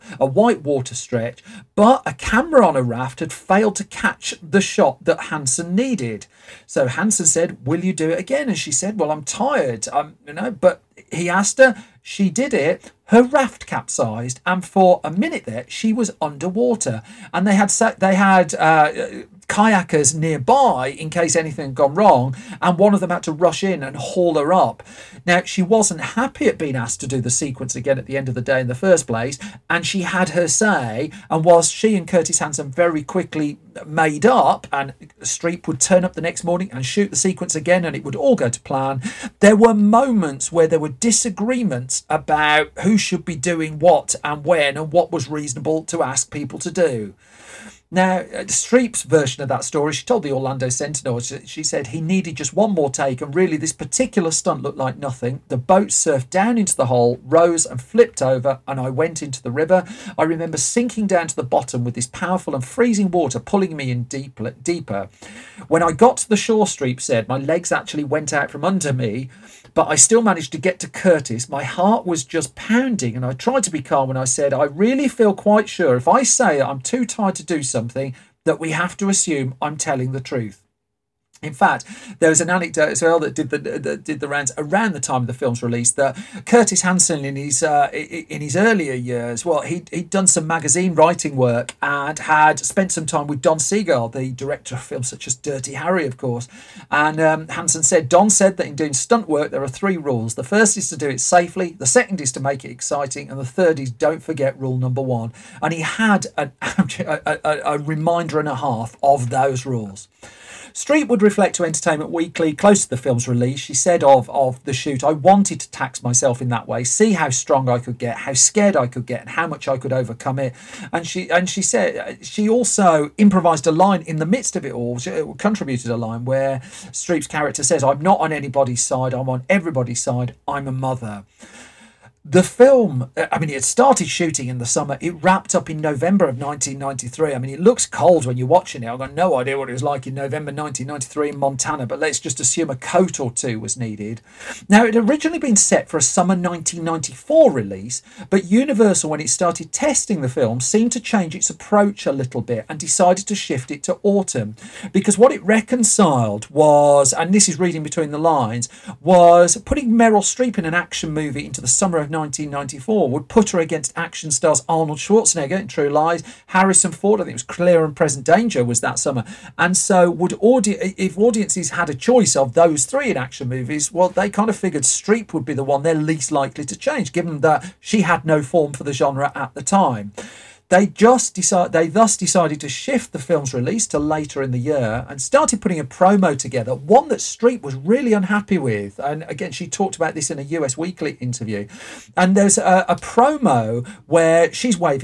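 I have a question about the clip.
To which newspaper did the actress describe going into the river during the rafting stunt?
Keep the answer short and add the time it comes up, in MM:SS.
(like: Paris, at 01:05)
Orlando Sentinel, at 00:50.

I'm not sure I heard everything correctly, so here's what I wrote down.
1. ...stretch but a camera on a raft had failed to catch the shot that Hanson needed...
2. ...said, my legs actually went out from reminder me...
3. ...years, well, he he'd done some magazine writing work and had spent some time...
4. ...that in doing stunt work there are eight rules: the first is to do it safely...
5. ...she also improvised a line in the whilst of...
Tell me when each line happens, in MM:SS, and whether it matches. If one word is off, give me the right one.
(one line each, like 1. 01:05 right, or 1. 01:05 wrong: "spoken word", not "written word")
1. 00:00 right
2. 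01:06 wrong: "under", not "reminder"
3. 01:28 right
4. 01:38 wrong: "three", not "eight"
5. 02:02 wrong: "midst", not "whilst".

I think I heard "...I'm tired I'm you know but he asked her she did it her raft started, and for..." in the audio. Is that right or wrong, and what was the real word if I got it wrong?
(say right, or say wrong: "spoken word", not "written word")
wrong: "capsized", not "started".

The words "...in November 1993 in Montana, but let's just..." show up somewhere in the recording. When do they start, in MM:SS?
02:20.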